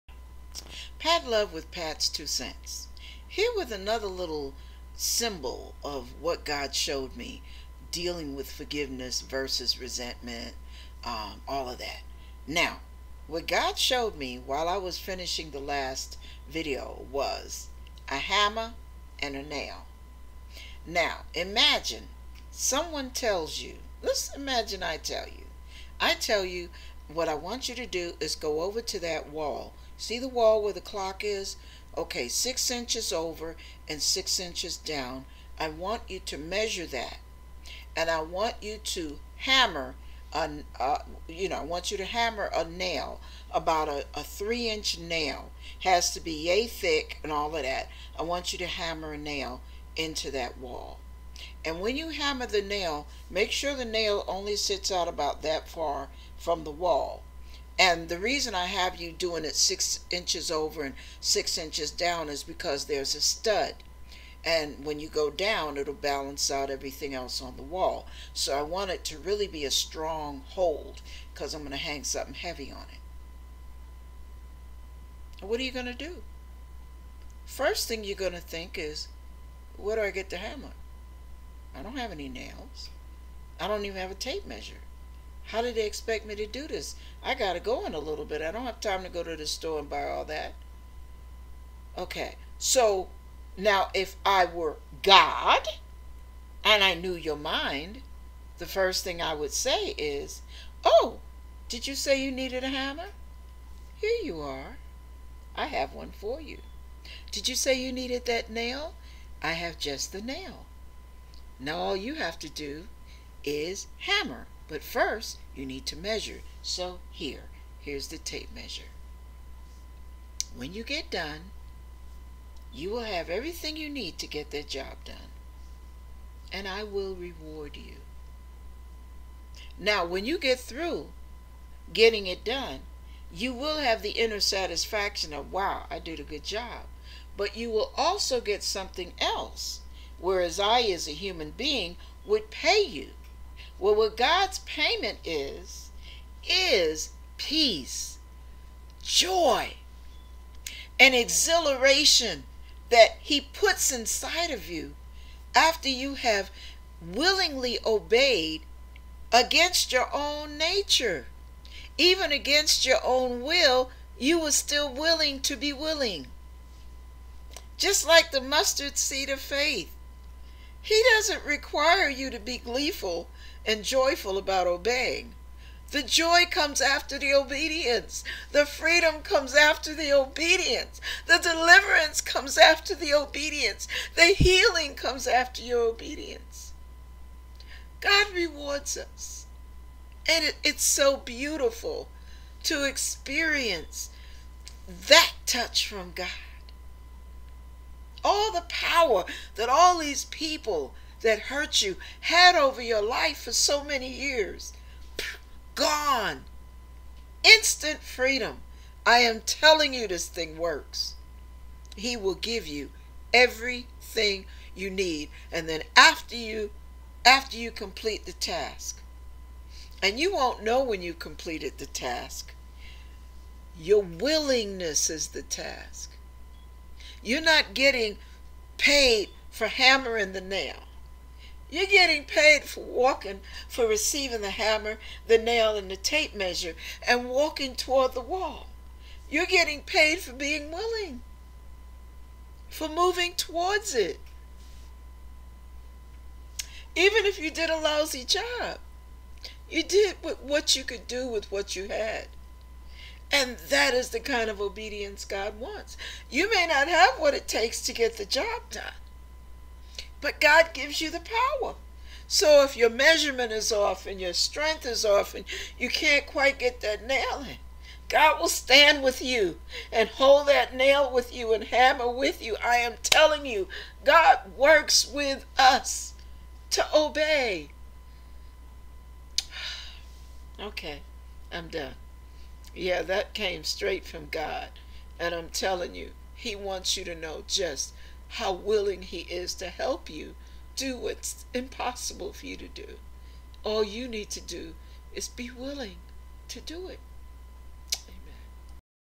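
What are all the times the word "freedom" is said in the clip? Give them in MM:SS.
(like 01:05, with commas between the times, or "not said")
02:58, 03:28.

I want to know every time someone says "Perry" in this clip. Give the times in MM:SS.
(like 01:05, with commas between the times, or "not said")
not said.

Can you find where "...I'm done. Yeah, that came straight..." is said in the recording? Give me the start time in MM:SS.
04:41.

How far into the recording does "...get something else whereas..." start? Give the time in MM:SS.
02:18.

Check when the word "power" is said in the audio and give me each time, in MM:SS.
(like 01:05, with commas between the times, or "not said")
03:18, 04:21.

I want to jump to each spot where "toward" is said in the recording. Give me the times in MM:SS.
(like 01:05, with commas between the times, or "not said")
03:57, 04:03.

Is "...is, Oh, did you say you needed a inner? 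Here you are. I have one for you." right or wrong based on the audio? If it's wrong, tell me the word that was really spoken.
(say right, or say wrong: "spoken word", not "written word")
wrong: "hammer", not "inner".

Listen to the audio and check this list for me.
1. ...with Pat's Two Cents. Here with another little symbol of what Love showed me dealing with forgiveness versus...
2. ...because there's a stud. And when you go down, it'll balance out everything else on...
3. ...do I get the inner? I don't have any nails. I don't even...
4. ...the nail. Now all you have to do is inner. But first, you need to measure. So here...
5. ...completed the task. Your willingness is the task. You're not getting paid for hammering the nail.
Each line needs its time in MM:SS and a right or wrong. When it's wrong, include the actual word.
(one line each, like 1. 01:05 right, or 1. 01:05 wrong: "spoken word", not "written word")
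1. 00:01 wrong: "God", not "Love"
2. 01:02 right
3. 01:19 wrong: "hammer", not "inner"
4. 01:50 wrong: "hammer", not "inner"
5. 03:41 right.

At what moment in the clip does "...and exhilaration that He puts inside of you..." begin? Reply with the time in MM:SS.
02:30.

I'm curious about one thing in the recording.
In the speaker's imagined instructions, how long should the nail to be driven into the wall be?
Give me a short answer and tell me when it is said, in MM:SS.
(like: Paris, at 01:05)
3 inch, at 00:44.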